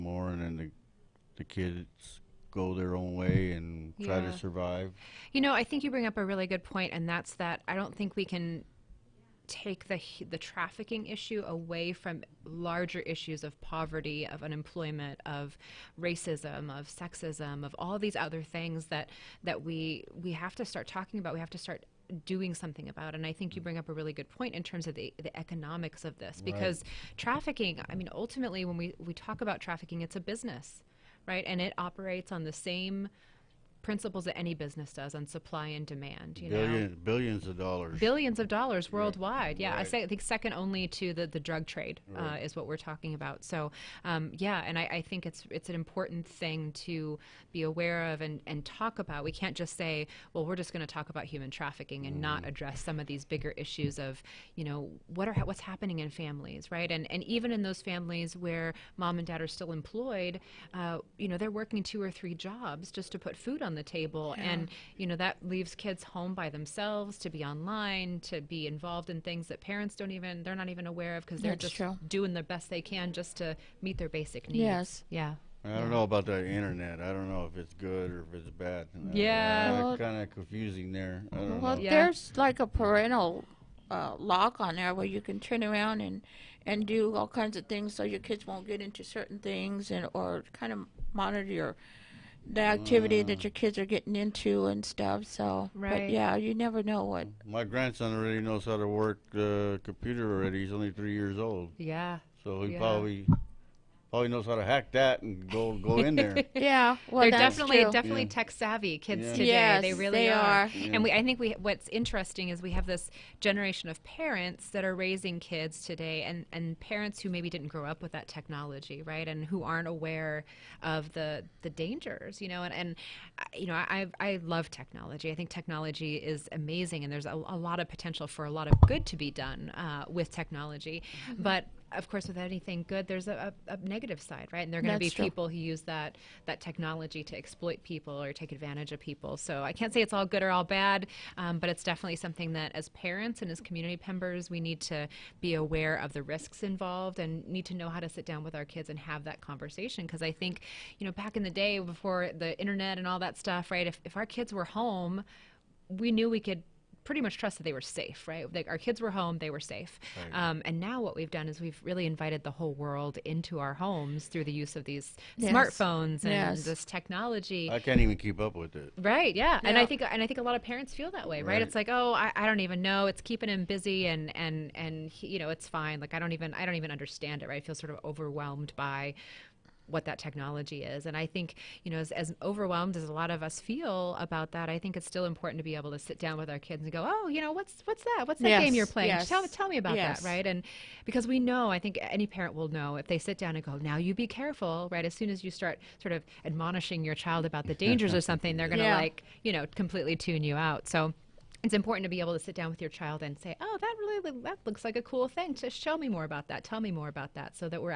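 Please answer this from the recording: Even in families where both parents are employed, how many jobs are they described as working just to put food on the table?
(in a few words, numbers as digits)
2 or 3 jobs.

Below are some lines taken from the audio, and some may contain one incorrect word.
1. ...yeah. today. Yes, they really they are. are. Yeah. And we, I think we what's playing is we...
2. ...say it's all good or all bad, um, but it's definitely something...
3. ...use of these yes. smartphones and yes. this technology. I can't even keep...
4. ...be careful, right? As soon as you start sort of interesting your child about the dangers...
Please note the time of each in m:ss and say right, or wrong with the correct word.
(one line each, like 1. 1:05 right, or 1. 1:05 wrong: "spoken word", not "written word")
1. 1:49 wrong: "interesting", not "playing"
2. 2:19 right
3. 2:44 right
4. 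3:14 wrong: "admonishing", not "interesting".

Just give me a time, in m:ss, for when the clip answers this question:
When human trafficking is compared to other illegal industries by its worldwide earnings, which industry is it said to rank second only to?
0:41.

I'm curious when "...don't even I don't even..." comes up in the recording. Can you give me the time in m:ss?
2:56.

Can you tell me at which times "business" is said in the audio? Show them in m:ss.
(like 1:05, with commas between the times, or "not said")
0:30, 0:34.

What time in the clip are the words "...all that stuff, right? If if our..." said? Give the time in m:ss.
2:33.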